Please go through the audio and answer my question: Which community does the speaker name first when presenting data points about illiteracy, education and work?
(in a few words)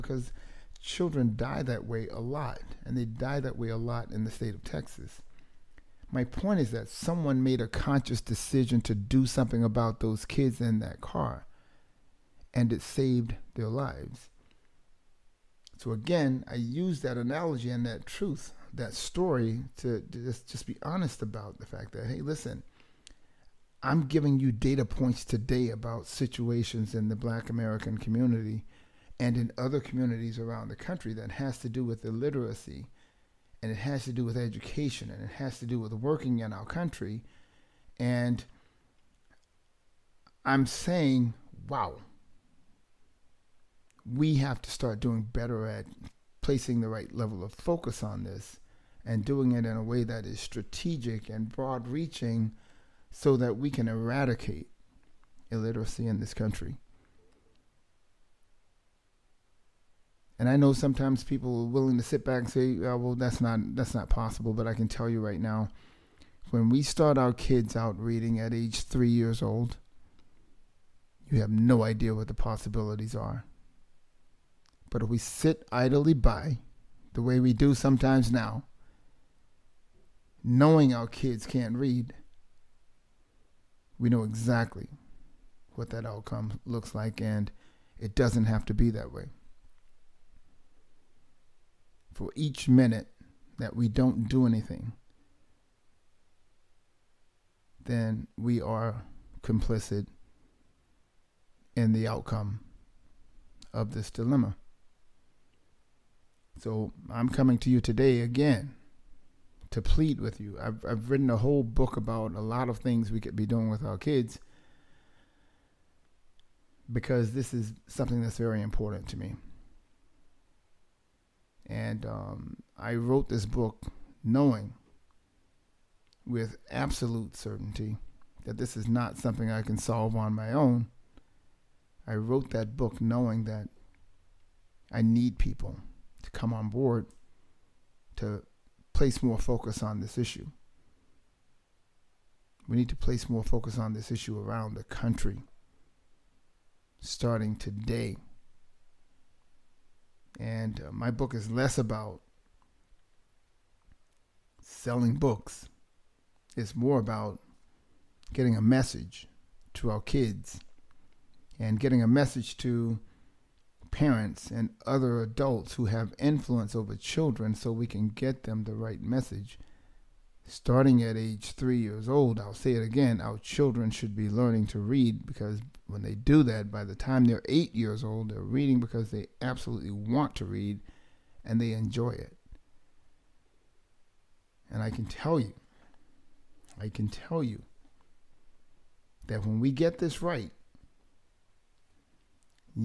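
Black American.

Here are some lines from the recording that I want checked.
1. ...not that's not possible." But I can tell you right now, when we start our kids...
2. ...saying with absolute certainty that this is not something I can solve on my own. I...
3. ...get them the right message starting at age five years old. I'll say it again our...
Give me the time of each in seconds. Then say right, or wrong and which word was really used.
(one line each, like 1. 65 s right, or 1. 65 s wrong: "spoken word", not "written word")
1. 63 s right
2. 124 s wrong: "knowing", not "saying"
3. 168 s wrong: "three", not "five".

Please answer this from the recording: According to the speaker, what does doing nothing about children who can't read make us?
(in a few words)
complicit.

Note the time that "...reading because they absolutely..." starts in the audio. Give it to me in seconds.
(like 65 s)
178 s.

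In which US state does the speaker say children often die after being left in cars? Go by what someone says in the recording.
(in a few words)
Texas.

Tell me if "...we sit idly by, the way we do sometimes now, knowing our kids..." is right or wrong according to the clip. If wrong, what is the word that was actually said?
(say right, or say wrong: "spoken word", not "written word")
right.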